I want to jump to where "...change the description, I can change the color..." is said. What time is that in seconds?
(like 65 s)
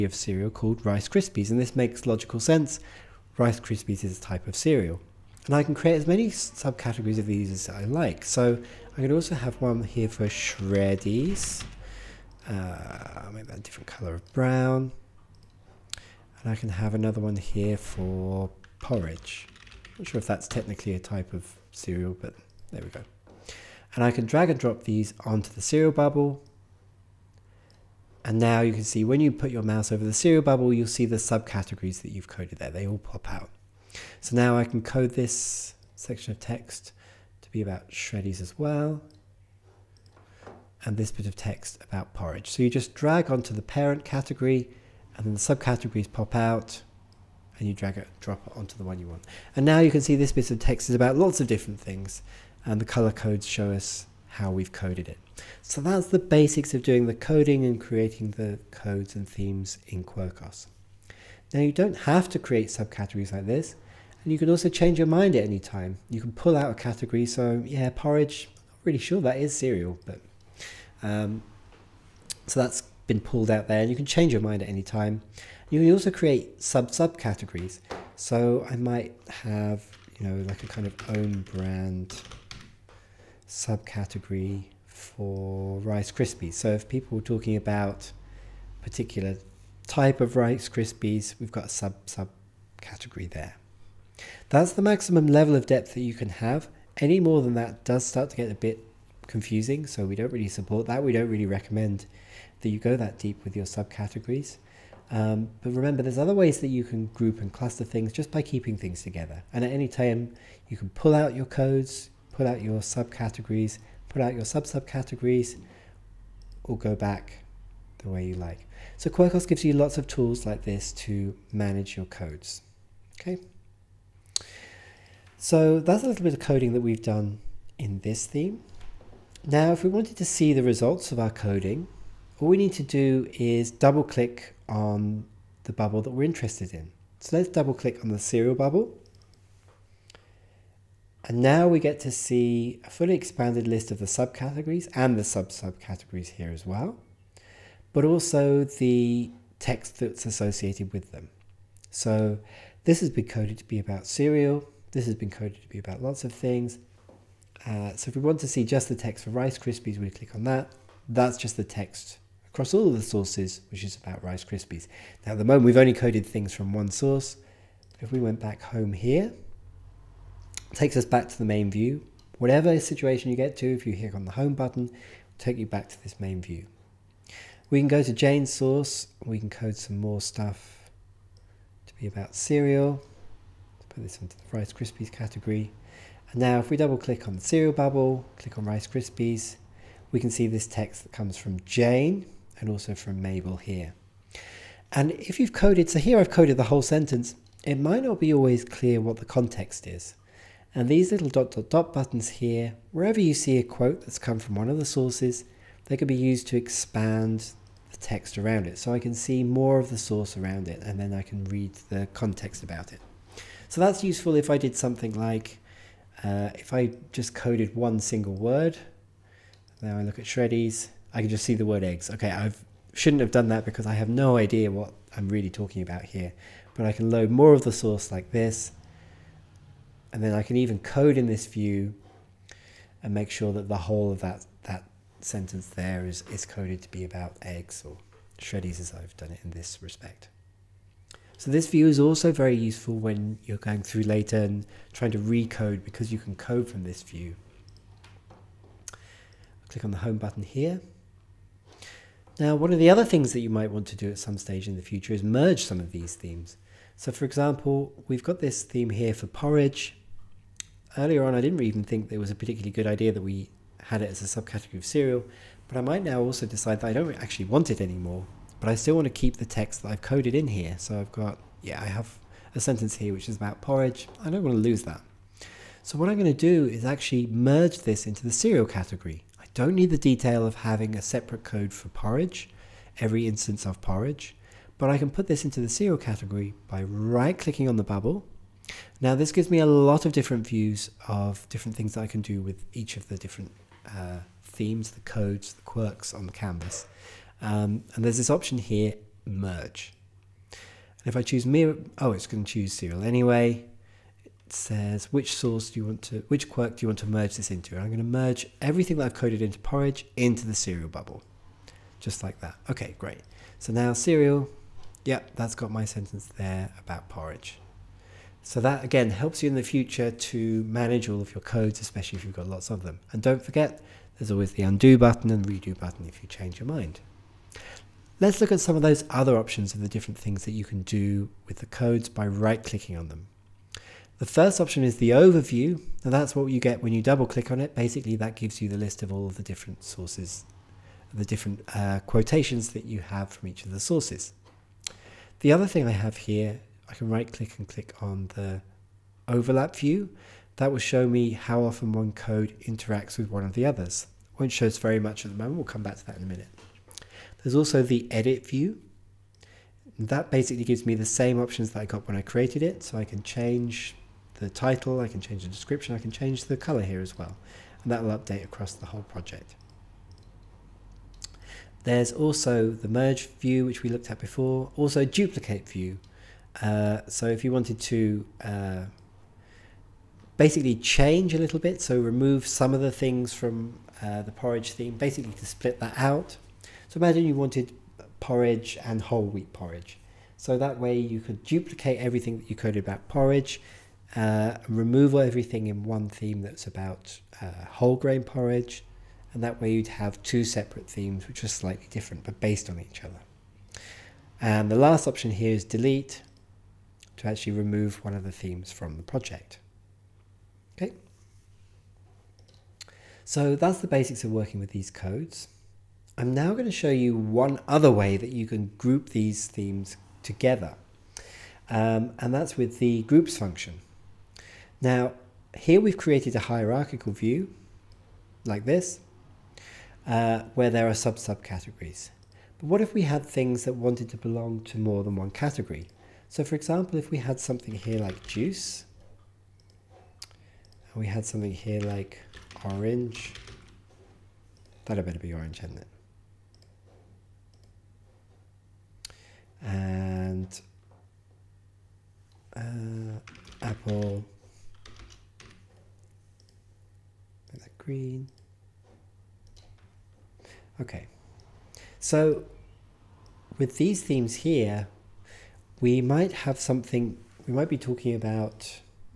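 365 s.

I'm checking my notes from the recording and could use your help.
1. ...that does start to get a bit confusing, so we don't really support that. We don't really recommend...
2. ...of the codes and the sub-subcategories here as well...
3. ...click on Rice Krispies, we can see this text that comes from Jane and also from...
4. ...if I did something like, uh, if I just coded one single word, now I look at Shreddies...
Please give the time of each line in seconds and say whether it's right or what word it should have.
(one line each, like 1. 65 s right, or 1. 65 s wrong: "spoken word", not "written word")
1. 97 s right
2. 143 s wrong: "subcategories", not "codes"
3. 188 s right
4. 214 s right.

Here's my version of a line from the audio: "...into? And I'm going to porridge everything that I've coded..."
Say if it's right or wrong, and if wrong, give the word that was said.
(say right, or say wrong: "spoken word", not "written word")
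wrong: "merge", not "porridge".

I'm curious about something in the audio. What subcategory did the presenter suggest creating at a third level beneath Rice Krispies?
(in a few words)
Own brand.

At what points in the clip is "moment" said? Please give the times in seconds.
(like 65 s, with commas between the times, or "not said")
165 s, 355 s.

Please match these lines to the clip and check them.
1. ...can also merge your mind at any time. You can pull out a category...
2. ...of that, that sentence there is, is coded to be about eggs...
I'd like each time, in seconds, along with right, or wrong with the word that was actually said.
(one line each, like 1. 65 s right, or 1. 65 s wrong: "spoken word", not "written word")
1. 64 s wrong: "change", not "merge"
2. 234 s right.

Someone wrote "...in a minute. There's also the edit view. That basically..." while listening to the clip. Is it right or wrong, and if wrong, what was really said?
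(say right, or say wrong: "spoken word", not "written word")
right.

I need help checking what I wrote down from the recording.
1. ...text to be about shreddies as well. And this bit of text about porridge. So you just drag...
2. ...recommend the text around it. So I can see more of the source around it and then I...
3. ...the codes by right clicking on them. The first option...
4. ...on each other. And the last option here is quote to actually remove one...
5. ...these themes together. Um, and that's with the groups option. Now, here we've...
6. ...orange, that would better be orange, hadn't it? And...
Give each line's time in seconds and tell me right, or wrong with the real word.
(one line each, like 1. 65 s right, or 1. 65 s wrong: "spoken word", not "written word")
1. 36 s right
2. 206 s wrong: "expand", not "recommend"
3. 331 s right
4. 402 s wrong: "delete", not "quote"
5. 419 s wrong: "function", not "option"
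6. 442 s right.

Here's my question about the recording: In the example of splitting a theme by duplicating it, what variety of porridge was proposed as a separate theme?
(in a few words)
Whole wheat porridge.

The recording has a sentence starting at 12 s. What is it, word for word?
Uh, I'll make that a different color of brown.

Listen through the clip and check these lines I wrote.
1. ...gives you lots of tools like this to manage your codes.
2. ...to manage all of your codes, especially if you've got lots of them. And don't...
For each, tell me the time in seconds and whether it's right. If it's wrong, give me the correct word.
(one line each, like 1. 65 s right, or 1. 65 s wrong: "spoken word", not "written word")
1. 119 s right
2. 320 s right.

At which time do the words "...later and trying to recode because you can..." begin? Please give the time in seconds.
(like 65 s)
244 s.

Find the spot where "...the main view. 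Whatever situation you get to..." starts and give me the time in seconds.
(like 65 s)
171 s.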